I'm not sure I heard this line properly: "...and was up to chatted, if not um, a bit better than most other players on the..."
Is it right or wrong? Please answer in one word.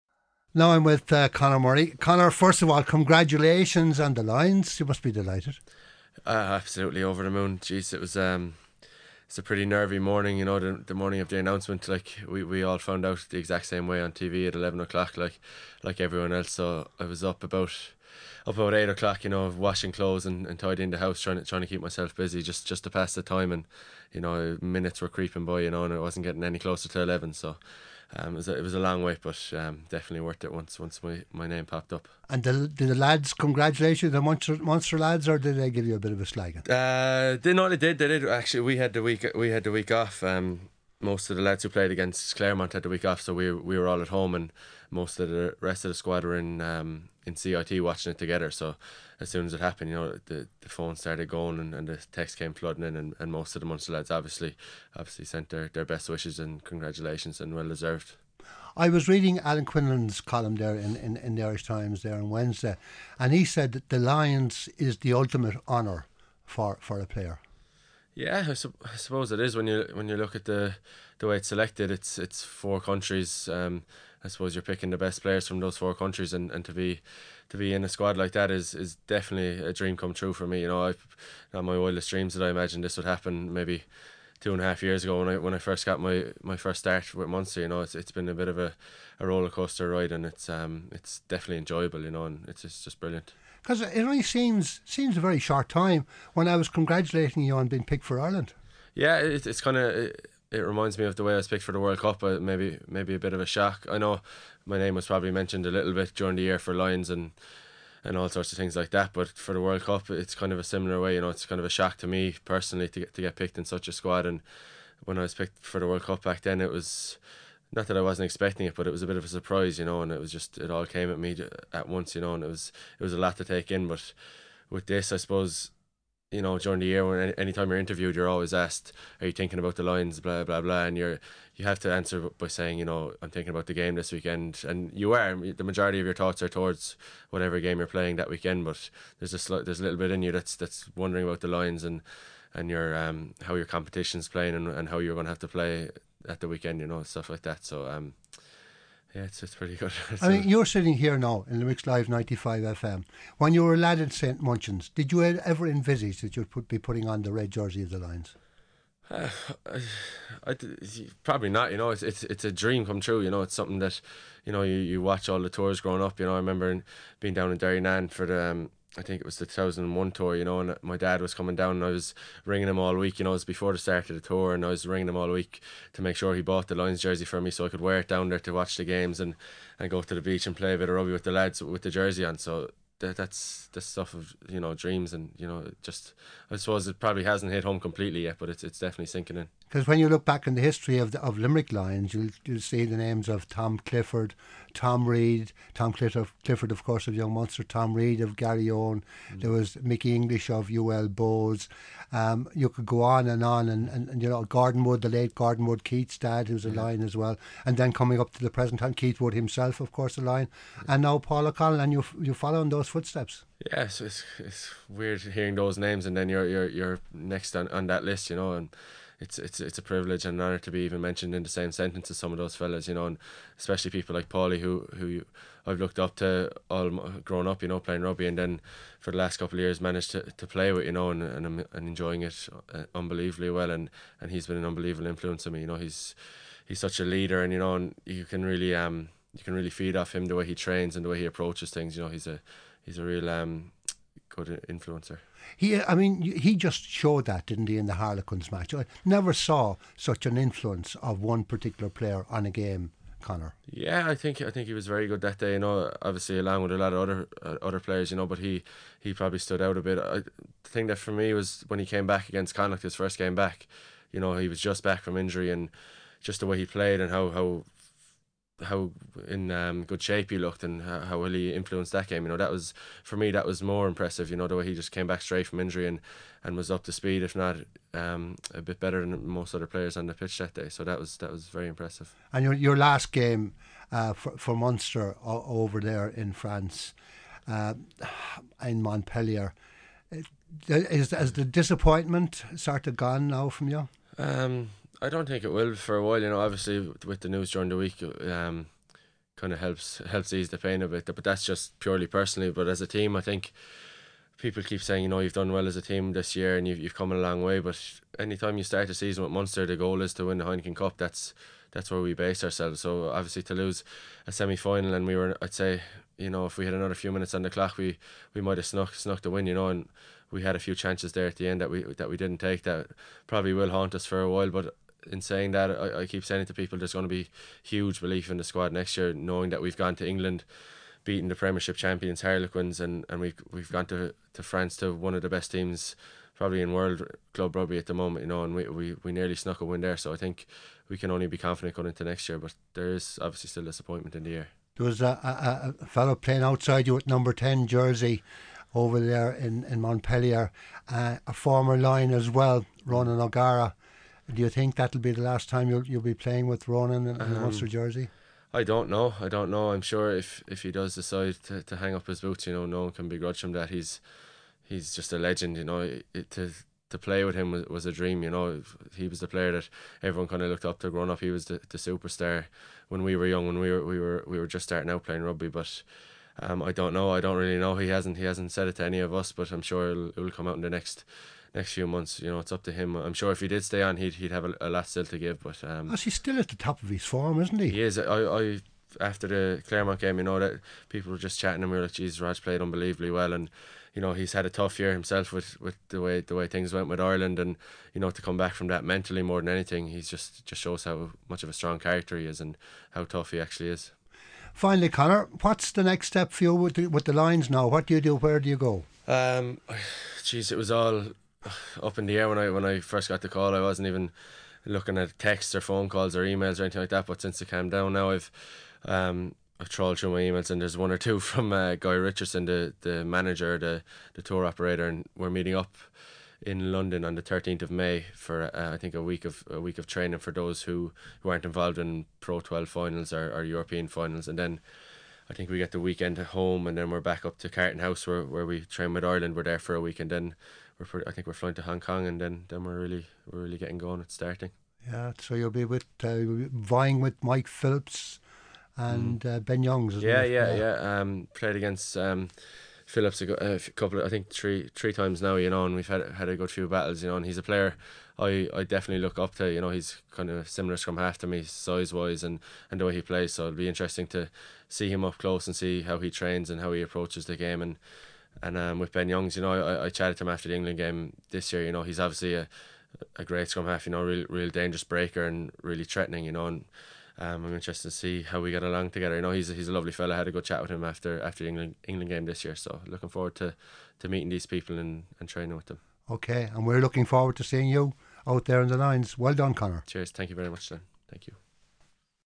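wrong.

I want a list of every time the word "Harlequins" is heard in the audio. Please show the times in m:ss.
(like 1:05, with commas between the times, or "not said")
4:07, 5:32.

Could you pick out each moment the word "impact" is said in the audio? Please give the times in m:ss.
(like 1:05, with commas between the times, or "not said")
not said.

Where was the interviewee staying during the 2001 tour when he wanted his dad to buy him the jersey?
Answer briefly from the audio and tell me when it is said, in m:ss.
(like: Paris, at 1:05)
Derrynane, at 2:47.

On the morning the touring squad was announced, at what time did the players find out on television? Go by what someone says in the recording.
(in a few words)
11 o'clock.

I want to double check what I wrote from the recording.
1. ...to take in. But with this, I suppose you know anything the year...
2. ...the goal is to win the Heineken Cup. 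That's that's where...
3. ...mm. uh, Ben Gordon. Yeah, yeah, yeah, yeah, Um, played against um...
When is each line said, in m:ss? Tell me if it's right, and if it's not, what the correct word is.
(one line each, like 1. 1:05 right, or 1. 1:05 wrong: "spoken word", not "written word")
1. 2:03 wrong: "during", not "anything"
2. 5:09 right
3. 7:29 wrong: "Youngs", not "Gordon".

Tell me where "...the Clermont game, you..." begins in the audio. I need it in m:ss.
6:29.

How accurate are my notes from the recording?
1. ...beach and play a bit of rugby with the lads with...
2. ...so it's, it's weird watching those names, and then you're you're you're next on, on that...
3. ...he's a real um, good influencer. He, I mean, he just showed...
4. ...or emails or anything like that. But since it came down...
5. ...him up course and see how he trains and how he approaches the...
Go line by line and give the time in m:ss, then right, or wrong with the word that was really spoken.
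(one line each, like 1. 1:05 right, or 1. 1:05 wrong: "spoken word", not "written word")
1. 3:00 right
2. 3:33 wrong: "hearing", not "watching"
3. 4:02 right
4. 6:56 right
5. 7:44 wrong: "close", not "course".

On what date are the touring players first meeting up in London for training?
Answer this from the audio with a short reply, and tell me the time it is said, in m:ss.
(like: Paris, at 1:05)
13 May, at 7:07.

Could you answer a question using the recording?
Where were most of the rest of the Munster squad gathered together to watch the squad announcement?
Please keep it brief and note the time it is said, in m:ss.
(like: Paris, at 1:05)
CIT, at 0:47.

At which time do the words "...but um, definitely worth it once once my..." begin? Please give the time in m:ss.
0:29.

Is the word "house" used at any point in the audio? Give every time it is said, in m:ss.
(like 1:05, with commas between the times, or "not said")
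0:20, 7:17.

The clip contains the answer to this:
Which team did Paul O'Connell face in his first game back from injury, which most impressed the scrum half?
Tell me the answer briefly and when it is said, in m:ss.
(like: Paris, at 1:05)
Connacht, at 4:22.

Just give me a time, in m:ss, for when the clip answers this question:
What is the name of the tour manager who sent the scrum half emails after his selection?
7:01.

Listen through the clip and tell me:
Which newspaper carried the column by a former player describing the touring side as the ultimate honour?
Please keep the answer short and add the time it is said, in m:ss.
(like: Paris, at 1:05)
The Irish Times, at 1:01.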